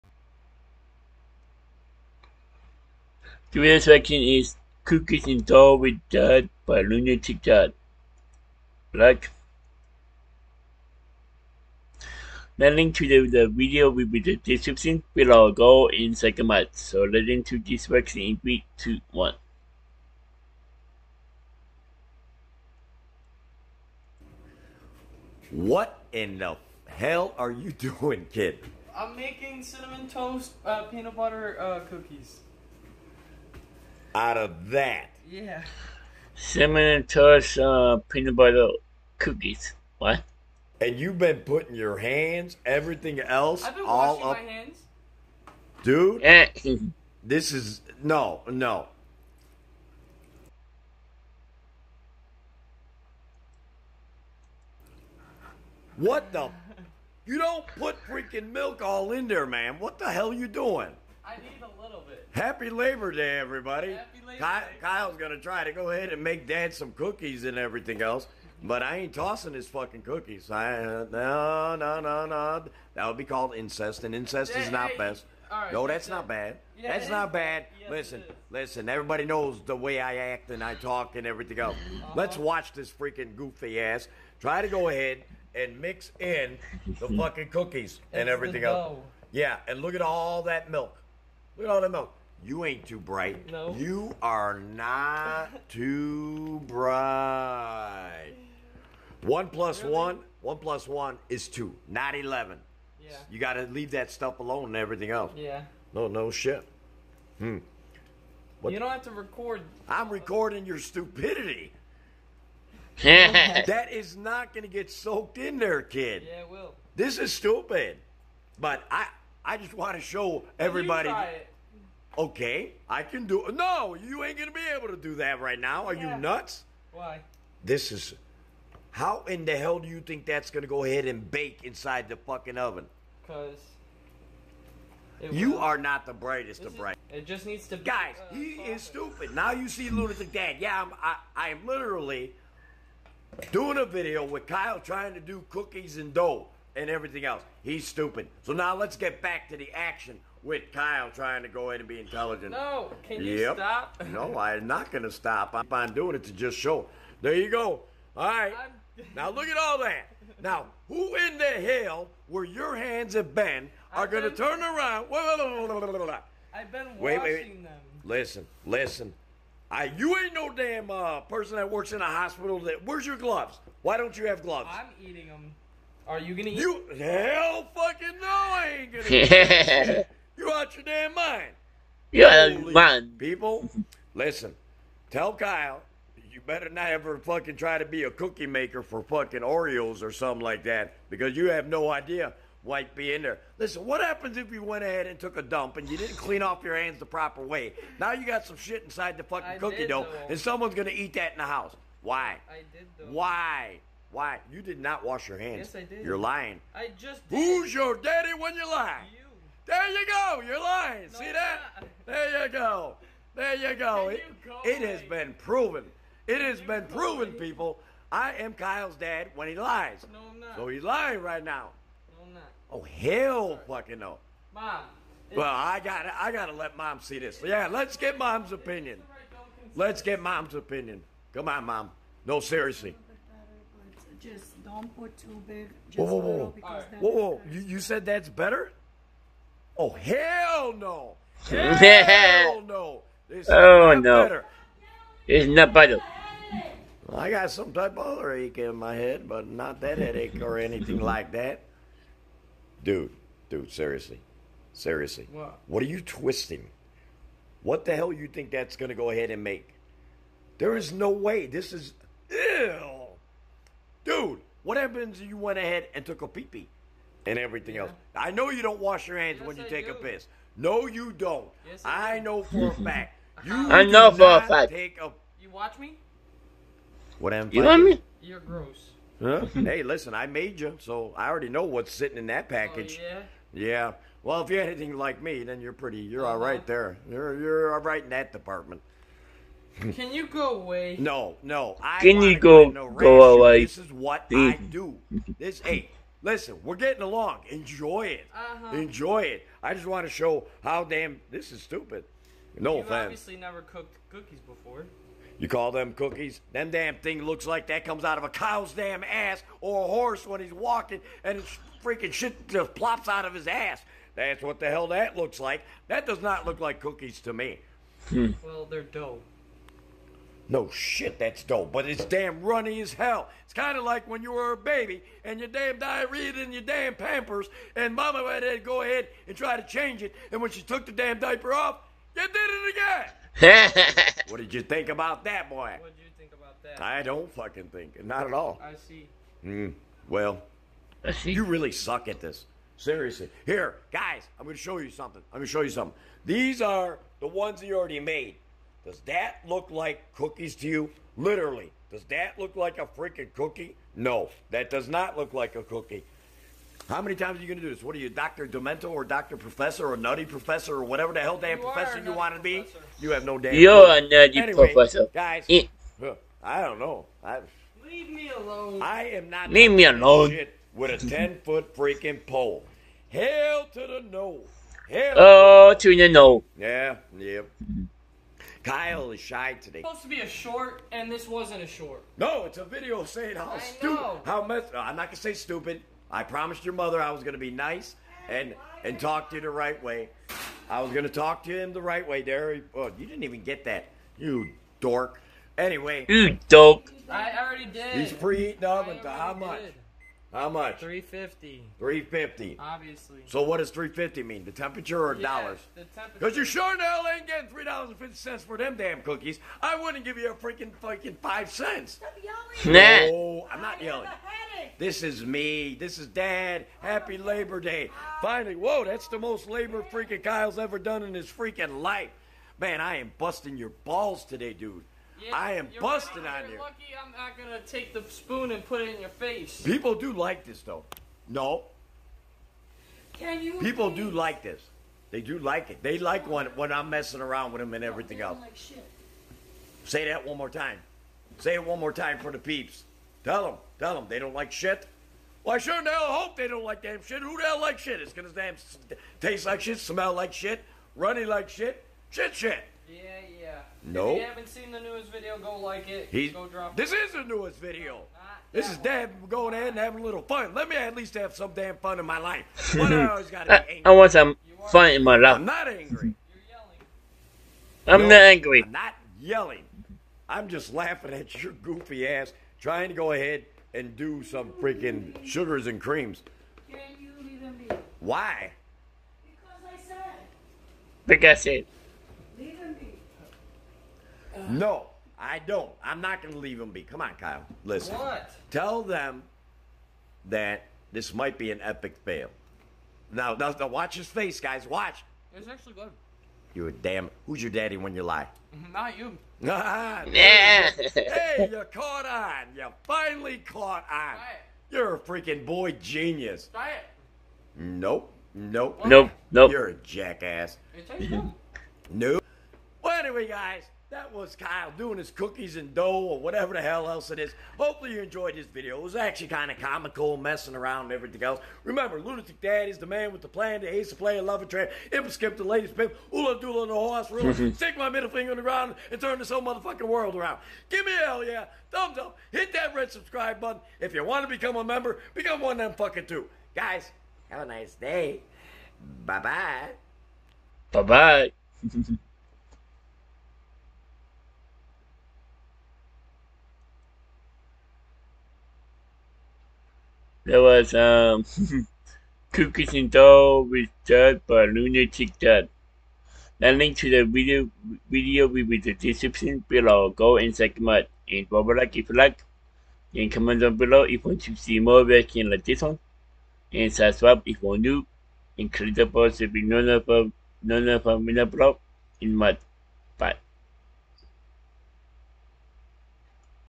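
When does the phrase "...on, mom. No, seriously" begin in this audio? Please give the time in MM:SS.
03:51.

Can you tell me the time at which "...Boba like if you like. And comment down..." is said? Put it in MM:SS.
09:21.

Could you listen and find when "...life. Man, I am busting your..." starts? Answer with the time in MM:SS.
07:01.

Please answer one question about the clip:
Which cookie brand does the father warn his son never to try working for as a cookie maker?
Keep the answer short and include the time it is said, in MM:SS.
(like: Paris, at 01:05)
Oreos, at 03:09.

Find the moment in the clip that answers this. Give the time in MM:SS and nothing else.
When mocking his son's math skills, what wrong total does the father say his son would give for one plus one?
01:42.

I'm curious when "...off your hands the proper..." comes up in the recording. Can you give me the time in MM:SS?
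03:16.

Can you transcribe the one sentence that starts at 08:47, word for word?
stick my middle finger in the ground and turn this whole motherfucking world around.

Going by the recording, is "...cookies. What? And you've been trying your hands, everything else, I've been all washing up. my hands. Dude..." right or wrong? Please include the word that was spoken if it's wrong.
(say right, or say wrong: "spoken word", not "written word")
wrong: "putting", not "trying".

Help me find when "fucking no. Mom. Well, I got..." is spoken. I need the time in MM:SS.
03:43.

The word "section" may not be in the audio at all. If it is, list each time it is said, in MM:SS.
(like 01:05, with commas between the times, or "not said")
00:03, 00:17.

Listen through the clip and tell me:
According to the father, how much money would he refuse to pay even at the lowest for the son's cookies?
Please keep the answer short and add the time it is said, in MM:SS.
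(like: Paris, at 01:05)
5 cents, at 06:51.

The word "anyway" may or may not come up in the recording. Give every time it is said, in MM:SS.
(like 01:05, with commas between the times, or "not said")
06:04, 06:35, 08:32.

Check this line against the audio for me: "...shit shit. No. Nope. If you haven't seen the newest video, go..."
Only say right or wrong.
right.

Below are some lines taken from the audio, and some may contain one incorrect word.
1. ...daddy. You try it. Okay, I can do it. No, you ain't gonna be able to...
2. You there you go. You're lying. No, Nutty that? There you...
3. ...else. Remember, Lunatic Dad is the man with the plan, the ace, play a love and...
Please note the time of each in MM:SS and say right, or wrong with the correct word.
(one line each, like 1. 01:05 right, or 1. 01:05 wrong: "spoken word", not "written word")
1. 02:00 wrong: "everybody", not "daddy"
2. 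03:29 wrong: "See", not "Nutty"
3. 08:41 right.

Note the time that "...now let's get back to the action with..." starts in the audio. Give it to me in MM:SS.
02:28.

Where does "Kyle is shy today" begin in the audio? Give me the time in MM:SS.
06:18.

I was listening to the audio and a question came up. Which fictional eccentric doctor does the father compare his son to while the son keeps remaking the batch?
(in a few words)
Dr. Demento.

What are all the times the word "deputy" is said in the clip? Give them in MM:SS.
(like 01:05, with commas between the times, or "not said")
not said.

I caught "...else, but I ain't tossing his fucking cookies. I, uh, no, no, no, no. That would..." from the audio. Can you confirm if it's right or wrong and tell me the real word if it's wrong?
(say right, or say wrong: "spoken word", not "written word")
right.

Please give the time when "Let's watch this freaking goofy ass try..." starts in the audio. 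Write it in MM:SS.
01:22.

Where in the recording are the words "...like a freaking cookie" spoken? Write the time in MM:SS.
05:52.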